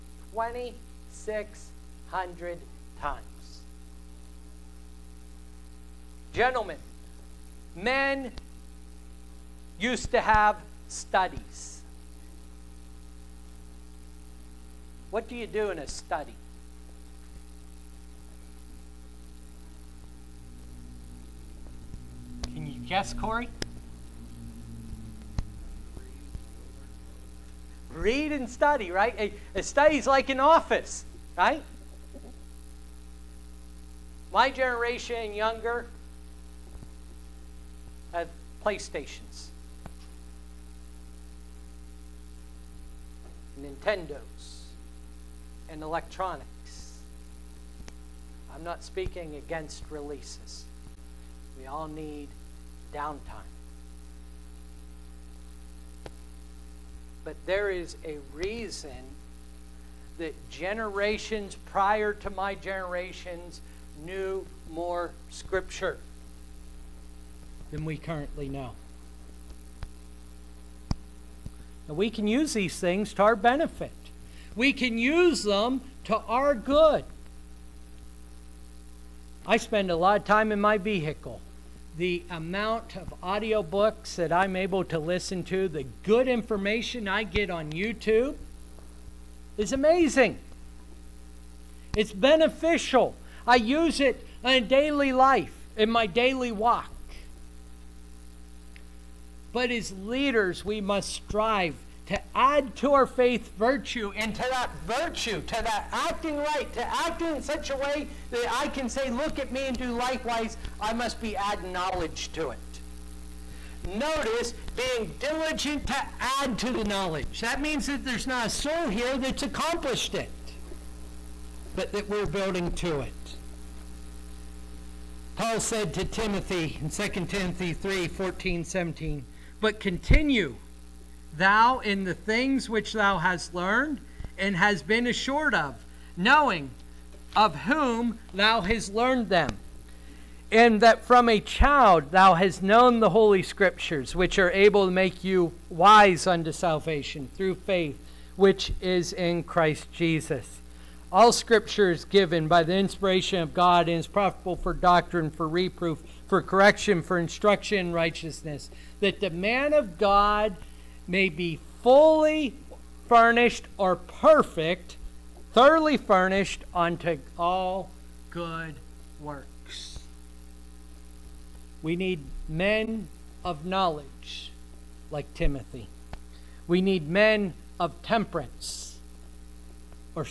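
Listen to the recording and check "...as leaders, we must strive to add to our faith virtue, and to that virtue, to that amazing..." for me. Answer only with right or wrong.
wrong.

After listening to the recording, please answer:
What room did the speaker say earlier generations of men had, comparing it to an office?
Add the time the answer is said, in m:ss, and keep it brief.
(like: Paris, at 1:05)
studies, at 0:10.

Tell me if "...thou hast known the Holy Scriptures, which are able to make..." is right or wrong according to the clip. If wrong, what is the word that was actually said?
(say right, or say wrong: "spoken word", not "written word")
right.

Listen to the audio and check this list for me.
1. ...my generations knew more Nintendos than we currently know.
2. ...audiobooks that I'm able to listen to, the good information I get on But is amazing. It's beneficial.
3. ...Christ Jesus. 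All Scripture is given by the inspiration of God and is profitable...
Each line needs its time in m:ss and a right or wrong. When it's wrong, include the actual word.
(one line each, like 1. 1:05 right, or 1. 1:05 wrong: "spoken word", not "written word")
1. 1:02 wrong: "Scripture", not "Nintendos"
2. 1:23 wrong: "YouTube", not "But"
3. 2:29 right.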